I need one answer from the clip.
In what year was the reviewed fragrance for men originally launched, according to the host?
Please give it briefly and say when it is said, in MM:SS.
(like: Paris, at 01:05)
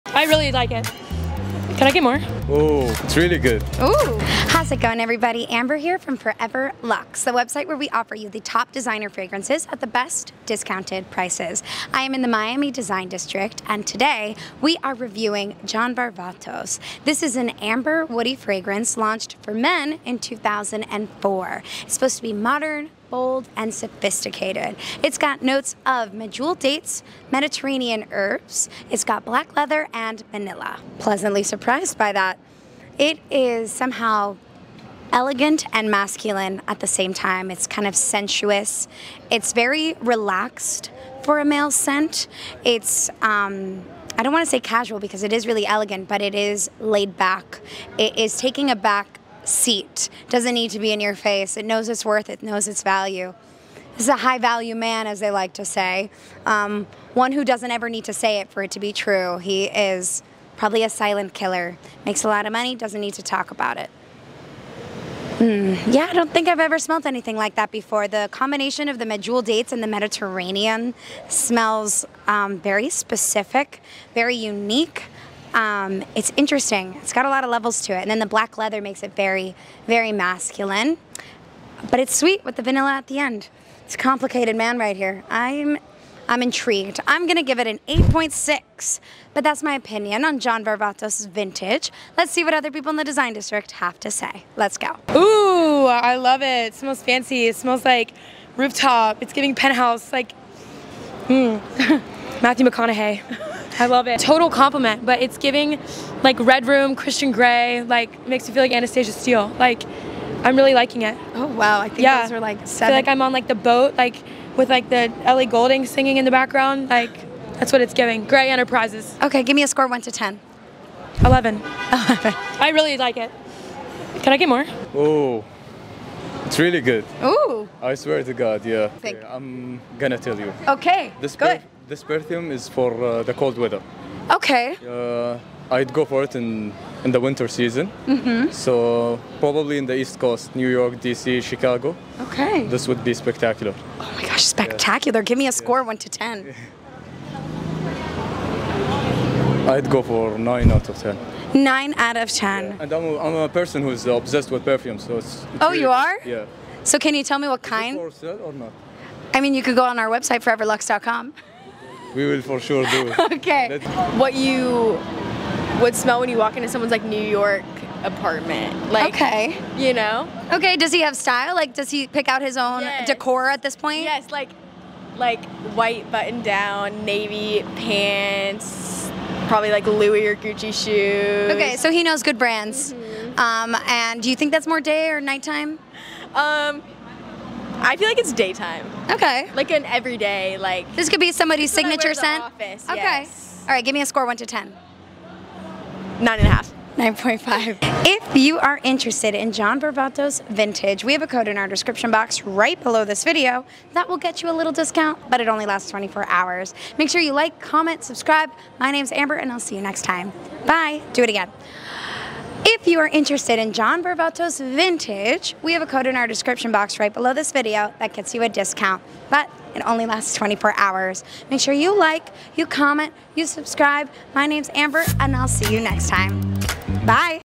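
2004, at 00:20.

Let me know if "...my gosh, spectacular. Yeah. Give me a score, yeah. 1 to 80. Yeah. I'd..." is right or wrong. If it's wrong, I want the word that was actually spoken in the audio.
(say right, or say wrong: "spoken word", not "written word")
wrong: "10", not "80".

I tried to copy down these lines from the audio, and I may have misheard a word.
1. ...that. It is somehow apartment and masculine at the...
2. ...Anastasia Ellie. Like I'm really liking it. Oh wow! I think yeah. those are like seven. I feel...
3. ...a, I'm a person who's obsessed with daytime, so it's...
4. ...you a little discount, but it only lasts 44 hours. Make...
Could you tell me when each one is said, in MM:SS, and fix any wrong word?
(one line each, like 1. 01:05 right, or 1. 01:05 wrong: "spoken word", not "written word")
1. 00:32 wrong: "elegant", not "apartment"
2. 01:48 wrong: "Steele", not "Ellie"
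3. 02:33 wrong: "perfume", not "daytime"
4. 03:24 wrong: "24", not "44".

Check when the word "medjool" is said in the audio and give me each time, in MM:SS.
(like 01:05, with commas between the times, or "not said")
00:26, 01:09.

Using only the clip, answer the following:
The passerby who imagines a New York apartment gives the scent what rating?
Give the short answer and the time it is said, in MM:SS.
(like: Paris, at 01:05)
9.5, at 03:16.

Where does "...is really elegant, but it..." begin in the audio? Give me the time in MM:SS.
00:45.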